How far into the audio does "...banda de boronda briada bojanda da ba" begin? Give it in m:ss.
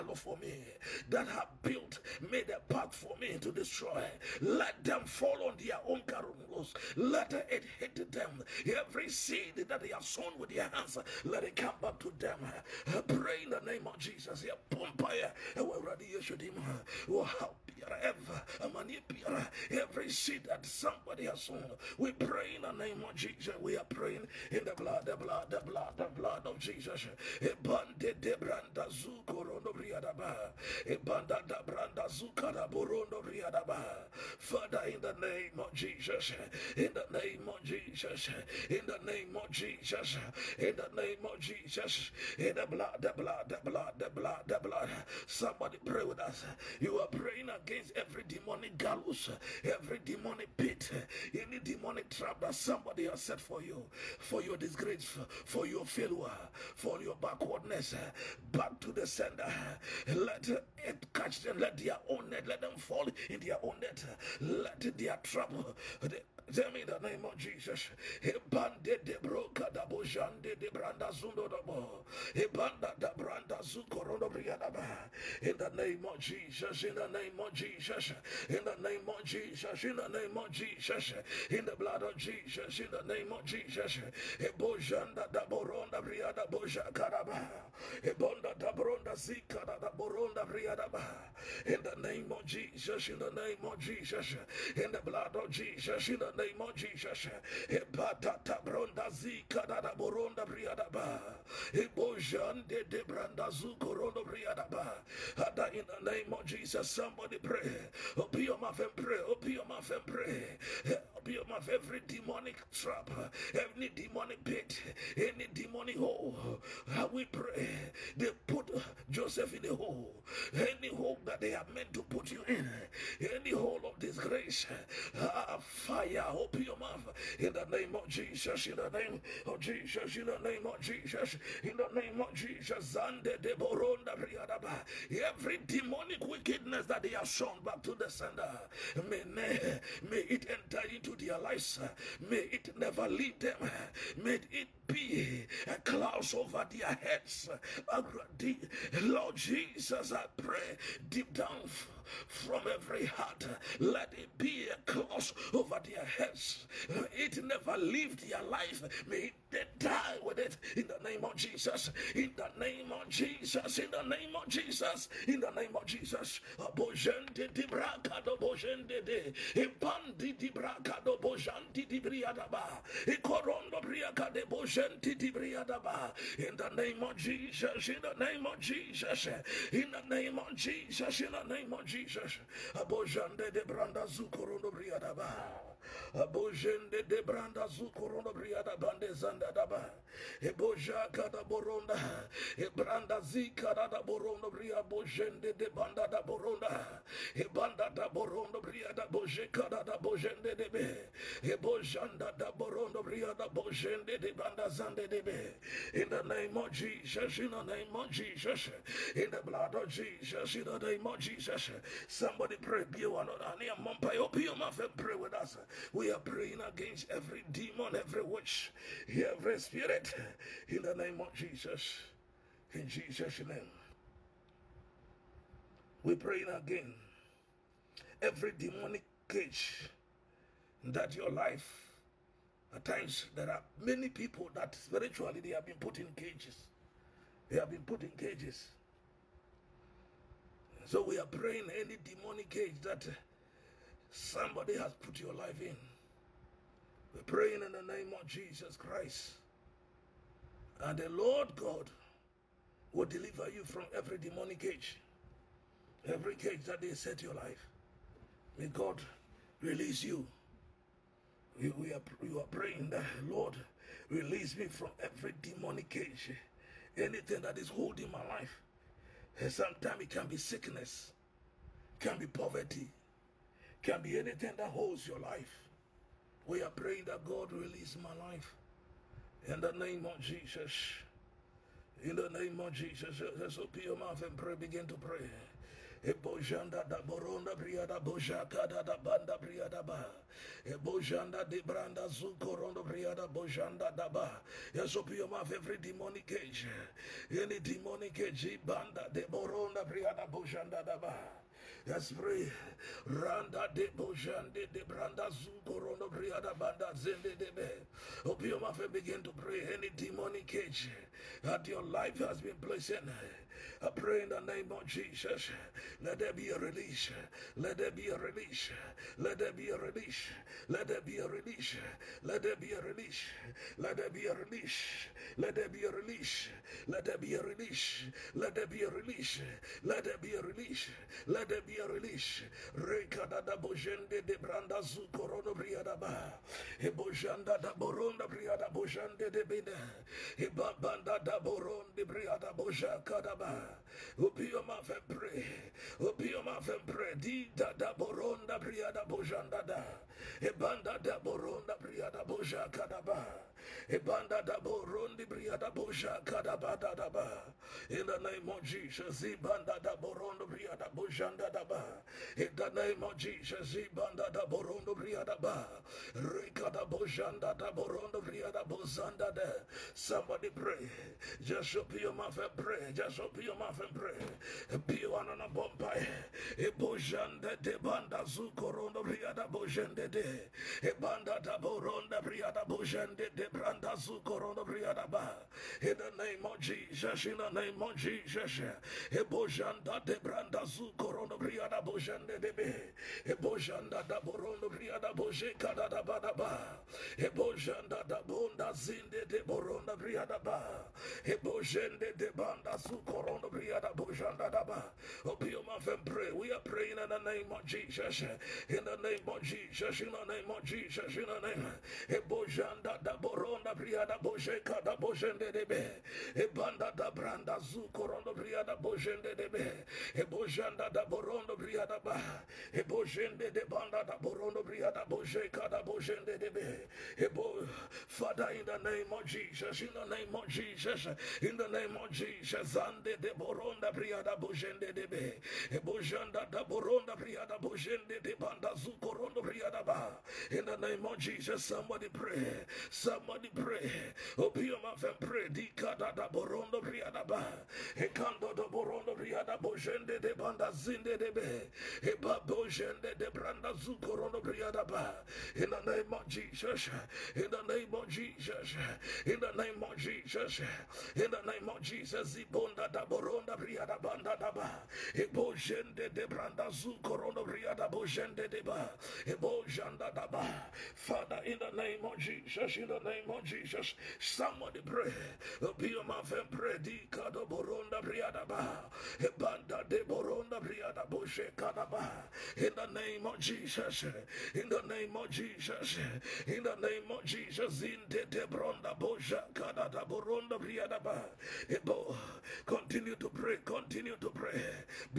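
4:58.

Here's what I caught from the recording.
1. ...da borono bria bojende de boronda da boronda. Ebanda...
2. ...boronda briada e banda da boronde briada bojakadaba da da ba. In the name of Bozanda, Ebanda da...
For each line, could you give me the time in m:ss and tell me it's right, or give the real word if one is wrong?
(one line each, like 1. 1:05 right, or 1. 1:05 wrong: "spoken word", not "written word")
1. 3:13 wrong: "banda", not "boronda"
2. 5:51 wrong: "Jesus", not "Bozanda".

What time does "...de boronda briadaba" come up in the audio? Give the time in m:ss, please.
7:59.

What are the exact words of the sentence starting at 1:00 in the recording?
Let it catch them, let their own net, let them fall in their own net, let their that trouble.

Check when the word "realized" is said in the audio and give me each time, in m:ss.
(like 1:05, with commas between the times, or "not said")
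not said.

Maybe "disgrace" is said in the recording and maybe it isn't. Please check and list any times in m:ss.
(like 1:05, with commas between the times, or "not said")
0:54, 2:03.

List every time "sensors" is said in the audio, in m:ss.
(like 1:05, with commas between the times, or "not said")
not said.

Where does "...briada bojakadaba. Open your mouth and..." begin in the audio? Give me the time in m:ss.
5:42.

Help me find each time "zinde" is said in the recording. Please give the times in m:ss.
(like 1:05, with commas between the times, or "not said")
6:38, 7:31.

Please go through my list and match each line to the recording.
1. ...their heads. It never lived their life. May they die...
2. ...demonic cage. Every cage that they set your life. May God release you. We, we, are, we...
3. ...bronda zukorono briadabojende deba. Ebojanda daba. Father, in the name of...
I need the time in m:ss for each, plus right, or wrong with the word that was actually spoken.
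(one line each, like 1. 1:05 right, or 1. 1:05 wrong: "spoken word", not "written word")
1. 2:35 right
2. 4:14 right
3. 7:46 wrong: "branda", not "bronda".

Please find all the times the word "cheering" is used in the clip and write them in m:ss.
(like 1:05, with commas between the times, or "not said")
not said.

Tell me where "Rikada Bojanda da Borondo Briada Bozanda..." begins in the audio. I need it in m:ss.
6:06.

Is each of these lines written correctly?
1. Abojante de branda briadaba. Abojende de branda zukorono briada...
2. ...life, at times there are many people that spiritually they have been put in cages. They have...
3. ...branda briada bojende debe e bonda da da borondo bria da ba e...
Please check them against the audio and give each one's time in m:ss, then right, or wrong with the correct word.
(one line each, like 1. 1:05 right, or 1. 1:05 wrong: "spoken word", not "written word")
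1. 3:02 right
2. 3:51 right
3. 6:57 wrong: "bojanda", not "bonda".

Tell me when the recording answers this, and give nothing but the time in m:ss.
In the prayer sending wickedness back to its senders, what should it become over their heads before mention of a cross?
2:25.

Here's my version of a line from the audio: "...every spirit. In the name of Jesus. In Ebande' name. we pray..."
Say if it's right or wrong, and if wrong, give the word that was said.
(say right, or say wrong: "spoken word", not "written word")
wrong: "Jesus", not "Ebande".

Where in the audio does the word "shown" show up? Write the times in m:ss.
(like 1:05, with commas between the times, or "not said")
2:17.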